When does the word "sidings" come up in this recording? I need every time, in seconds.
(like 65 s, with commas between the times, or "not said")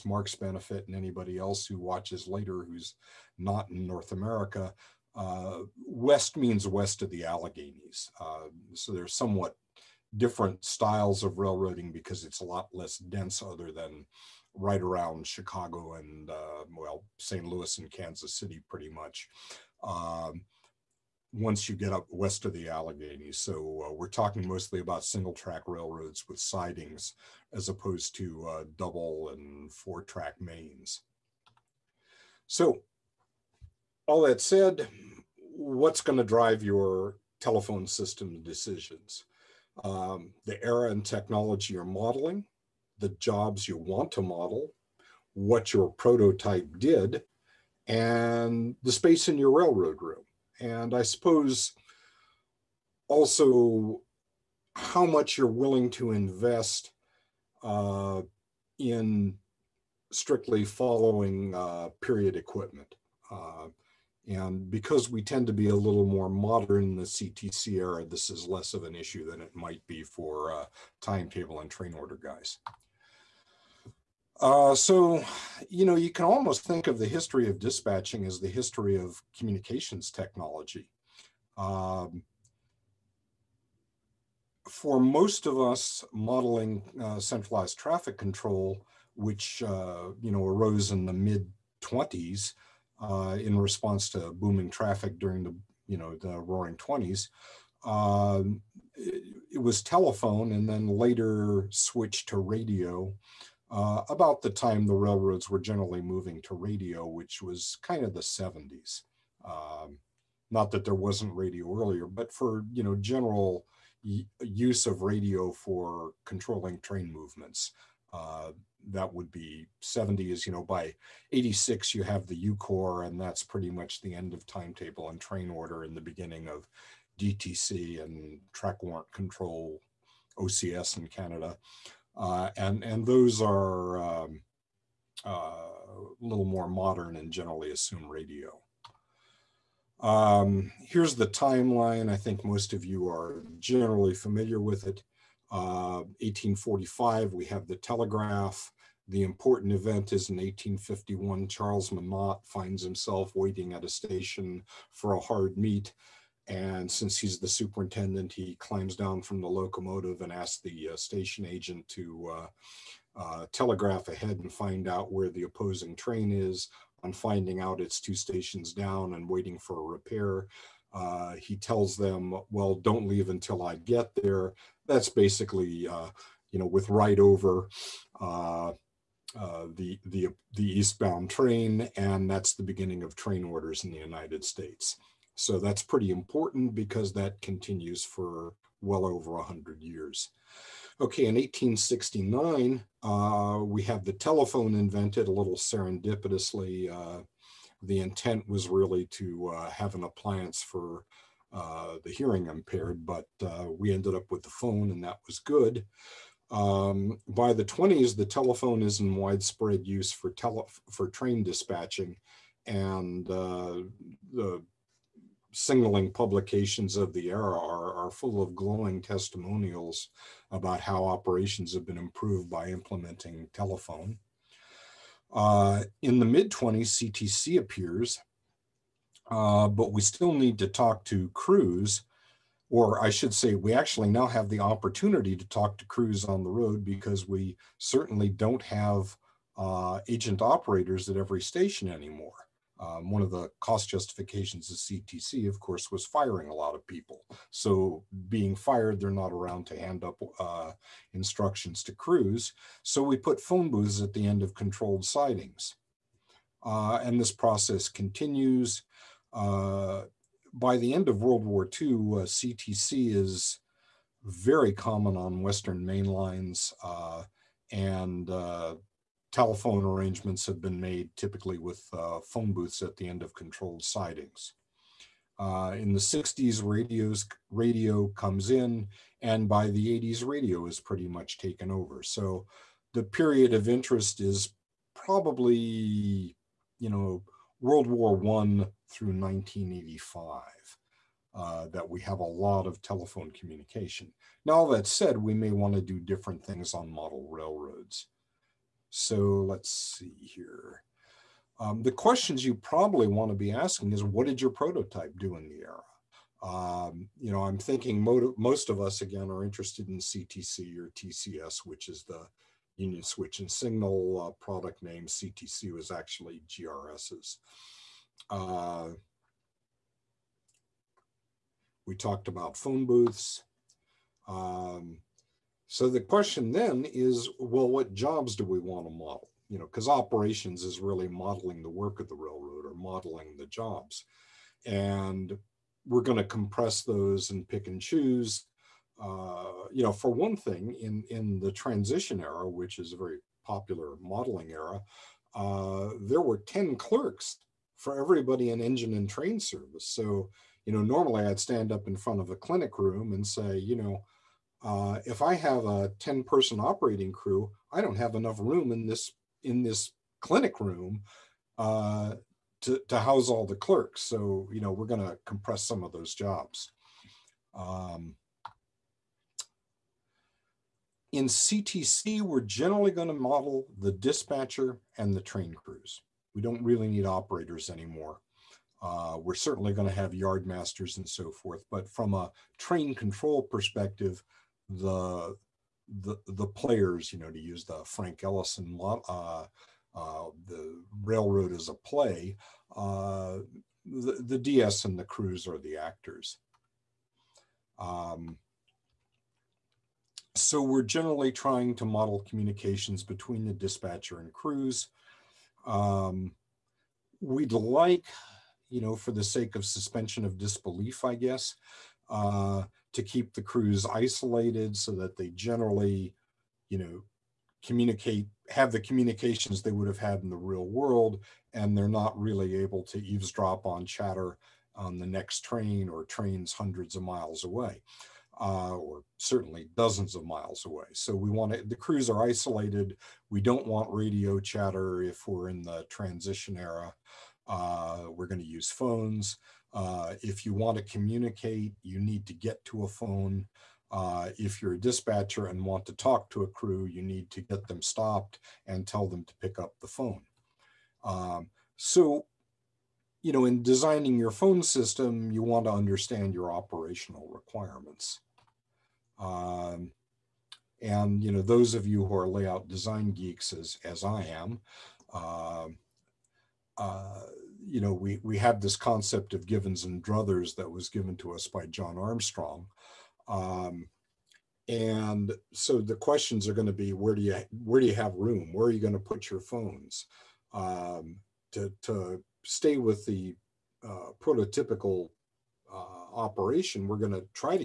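26 s, 255 s, 273 s.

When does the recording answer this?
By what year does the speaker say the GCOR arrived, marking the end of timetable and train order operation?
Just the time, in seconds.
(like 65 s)
121 s.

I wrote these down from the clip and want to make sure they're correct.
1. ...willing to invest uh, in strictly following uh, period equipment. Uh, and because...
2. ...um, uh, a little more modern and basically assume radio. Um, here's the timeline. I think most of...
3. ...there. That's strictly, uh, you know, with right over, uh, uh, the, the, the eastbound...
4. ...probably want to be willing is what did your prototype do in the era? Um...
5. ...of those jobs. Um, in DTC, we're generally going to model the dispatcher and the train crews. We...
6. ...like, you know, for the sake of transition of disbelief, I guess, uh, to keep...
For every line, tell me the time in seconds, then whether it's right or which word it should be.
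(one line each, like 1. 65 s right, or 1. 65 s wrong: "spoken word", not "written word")
1. 55 s right
2. 134 s wrong: "generally", not "basically"
3. 174 s wrong: "basically", not "strictly"
4. 302 s wrong: "asking", not "willing"
5. 365 s wrong: "CTC", not "DTC"
6. 407 s wrong: "suspension", not "transition".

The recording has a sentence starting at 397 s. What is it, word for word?
Um, so we're generally trying to model communications between the dispatcher and crews.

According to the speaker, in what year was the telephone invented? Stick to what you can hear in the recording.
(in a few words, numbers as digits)
1869.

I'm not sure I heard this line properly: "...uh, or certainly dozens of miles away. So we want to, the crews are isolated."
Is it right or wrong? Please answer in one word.
right.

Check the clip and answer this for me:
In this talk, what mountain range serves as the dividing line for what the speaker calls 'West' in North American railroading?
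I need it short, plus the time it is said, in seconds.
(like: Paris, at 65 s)
Alleghenies, at 7 s.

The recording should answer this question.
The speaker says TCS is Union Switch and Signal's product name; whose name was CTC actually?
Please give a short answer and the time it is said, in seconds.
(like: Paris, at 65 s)
GRS, at 316 s.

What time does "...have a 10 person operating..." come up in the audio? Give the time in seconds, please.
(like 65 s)
355 s.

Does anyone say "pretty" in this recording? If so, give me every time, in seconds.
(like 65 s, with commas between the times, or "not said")
18 s, 123 s, 185 s, 280 s.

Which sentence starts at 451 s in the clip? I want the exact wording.
Um, so you know, in designing your phone system, you want to understand your operational requirements.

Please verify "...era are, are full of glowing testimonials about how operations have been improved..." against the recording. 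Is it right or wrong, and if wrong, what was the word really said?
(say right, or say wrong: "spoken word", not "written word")
right.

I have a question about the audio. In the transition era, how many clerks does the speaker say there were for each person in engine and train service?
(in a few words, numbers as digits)
10.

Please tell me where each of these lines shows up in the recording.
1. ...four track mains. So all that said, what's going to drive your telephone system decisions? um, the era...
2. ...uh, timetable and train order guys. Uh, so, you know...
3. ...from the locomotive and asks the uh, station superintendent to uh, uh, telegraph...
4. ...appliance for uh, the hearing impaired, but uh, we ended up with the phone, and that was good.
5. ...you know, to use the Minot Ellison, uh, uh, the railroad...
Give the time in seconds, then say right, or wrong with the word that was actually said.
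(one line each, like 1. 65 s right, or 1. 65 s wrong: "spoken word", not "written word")
1. 29 s right
2. 70 s right
3. 159 s wrong: "agent", not "superintendent"
4. 200 s right
5. 387 s wrong: "Frank", not "Minot".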